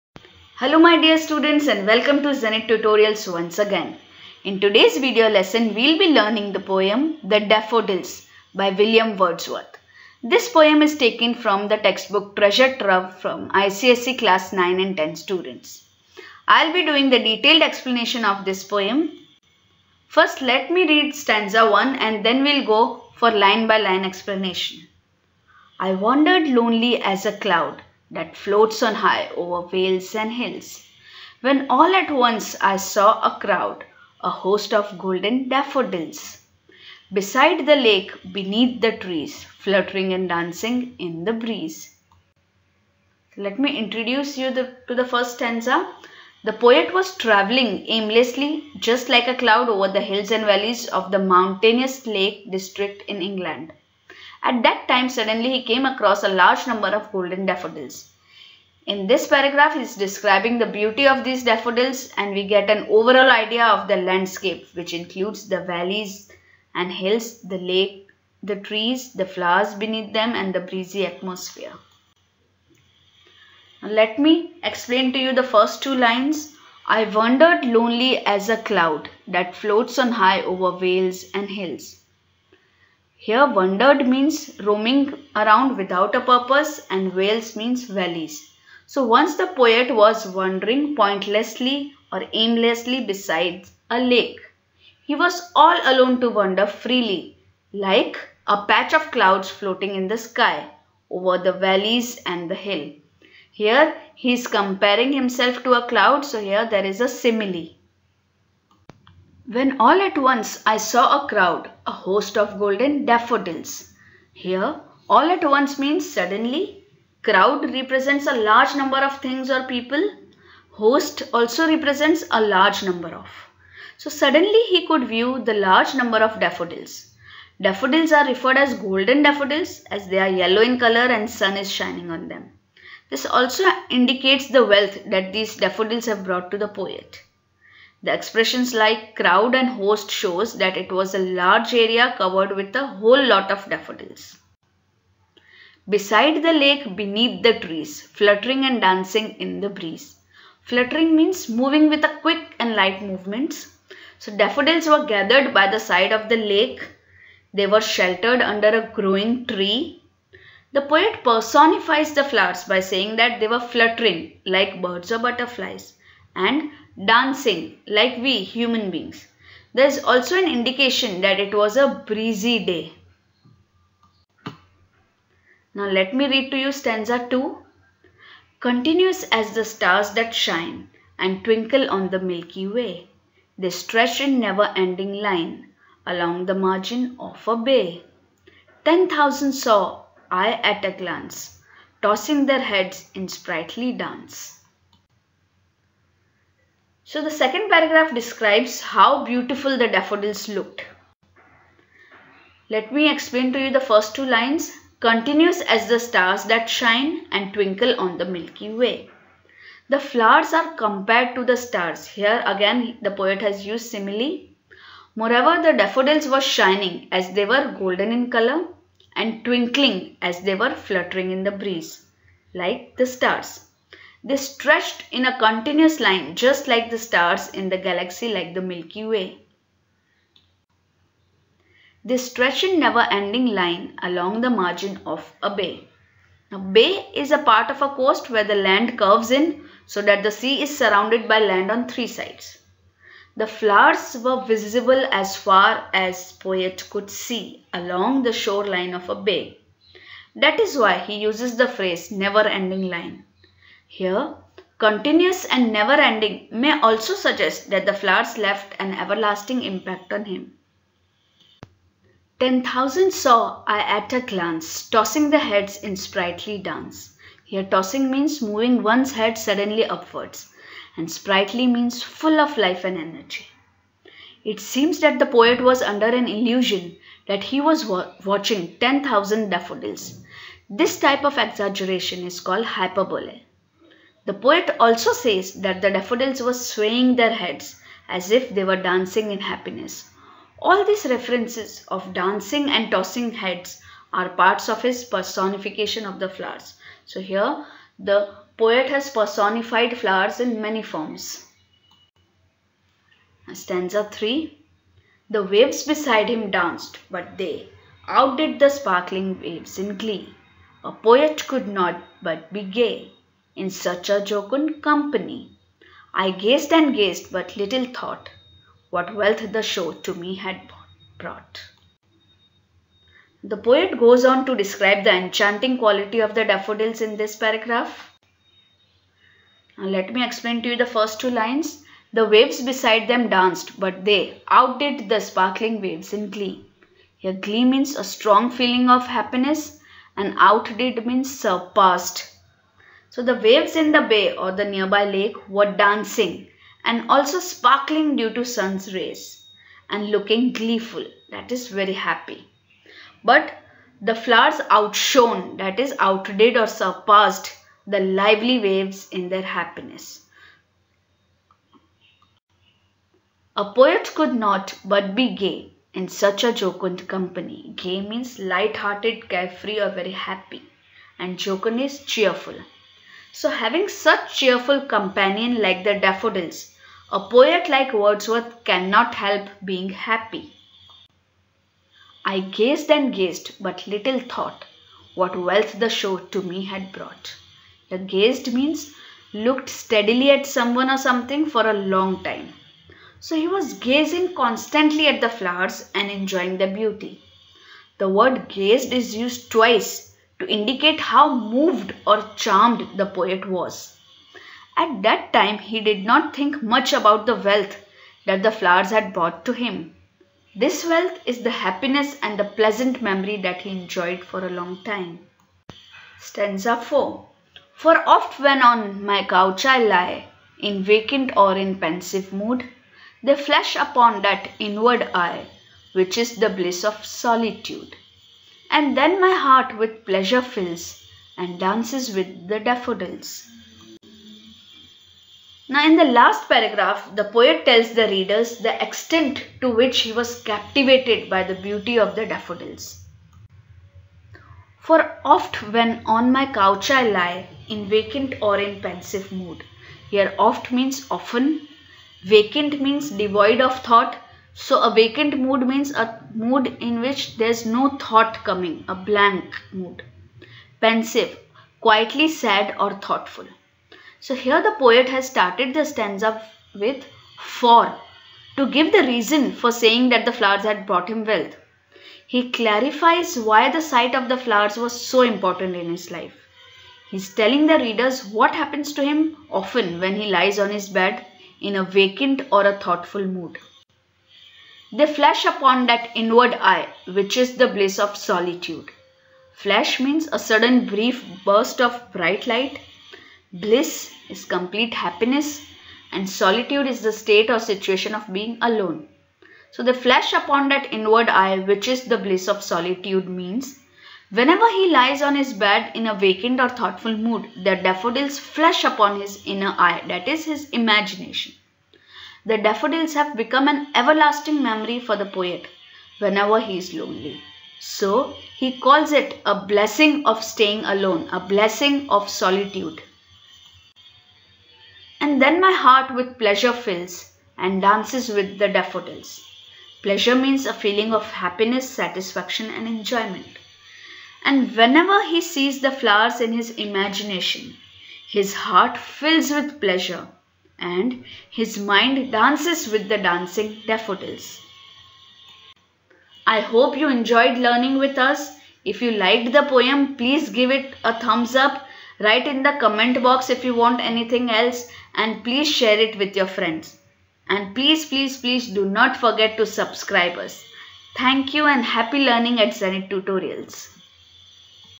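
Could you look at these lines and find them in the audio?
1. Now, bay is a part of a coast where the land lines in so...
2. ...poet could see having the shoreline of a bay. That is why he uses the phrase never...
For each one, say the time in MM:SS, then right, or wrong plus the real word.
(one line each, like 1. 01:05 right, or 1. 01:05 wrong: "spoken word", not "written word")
1. 03:56 wrong: "curves", not "lines"
2. 04:06 wrong: "along", not "having".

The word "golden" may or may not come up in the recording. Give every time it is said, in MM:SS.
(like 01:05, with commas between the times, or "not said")
00:34, 00:57, 01:52, 02:08, 03:37.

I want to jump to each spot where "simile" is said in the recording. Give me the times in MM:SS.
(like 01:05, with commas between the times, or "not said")
01:47, 03:33.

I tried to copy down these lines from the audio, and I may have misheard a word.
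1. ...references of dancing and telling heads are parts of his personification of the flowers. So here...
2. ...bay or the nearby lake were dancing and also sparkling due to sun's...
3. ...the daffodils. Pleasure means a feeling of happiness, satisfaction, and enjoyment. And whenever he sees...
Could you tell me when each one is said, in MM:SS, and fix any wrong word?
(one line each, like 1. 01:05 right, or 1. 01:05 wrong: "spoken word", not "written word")
1. 04:51 wrong: "tossing", not "telling"
2. 05:44 right
3. 08:48 right.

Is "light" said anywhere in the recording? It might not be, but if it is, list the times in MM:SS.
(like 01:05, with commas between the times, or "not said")
02:32, 06:08, 08:12.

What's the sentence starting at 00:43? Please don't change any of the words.
Let me introduce you the, to the first stanza.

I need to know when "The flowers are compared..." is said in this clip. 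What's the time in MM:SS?
03:29.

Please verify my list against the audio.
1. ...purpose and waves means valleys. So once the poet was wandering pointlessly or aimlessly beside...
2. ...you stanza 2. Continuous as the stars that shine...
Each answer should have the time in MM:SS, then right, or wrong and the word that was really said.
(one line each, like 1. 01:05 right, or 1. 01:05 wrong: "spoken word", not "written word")
1. 01:26 wrong: "vales", not "waves"
2. 02:56 right.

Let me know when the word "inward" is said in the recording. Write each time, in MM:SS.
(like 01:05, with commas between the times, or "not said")
07:04, 08:06, 08:20.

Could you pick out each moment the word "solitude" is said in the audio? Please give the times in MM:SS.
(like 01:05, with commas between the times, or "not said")
07:07, 08:08, 08:16, 08:22, 08:42.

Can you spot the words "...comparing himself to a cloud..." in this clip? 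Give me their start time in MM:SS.
01:44.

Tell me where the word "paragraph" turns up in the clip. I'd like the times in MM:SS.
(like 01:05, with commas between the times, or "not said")
00:59, 03:17, 05:27, 07:16.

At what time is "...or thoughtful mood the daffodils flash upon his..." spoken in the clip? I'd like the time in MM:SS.
08:26.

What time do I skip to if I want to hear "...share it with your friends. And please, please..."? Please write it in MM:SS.
09:15.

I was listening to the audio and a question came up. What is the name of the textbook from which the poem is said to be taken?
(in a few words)
Treasure Trove.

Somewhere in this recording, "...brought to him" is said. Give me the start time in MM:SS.
06:49.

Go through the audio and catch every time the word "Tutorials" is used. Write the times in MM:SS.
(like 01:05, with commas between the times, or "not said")
00:02, 09:23.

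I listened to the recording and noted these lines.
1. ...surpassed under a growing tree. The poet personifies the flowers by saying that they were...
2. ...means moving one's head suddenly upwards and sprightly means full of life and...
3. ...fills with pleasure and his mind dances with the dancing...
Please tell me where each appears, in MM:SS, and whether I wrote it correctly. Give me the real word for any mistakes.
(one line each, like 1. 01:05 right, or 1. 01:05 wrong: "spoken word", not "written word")
1. 02:37 wrong: "sheltered", not "surpassed"
2. 04:28 right
3. 08:58 right.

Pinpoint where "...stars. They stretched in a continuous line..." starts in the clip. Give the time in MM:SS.
03:43.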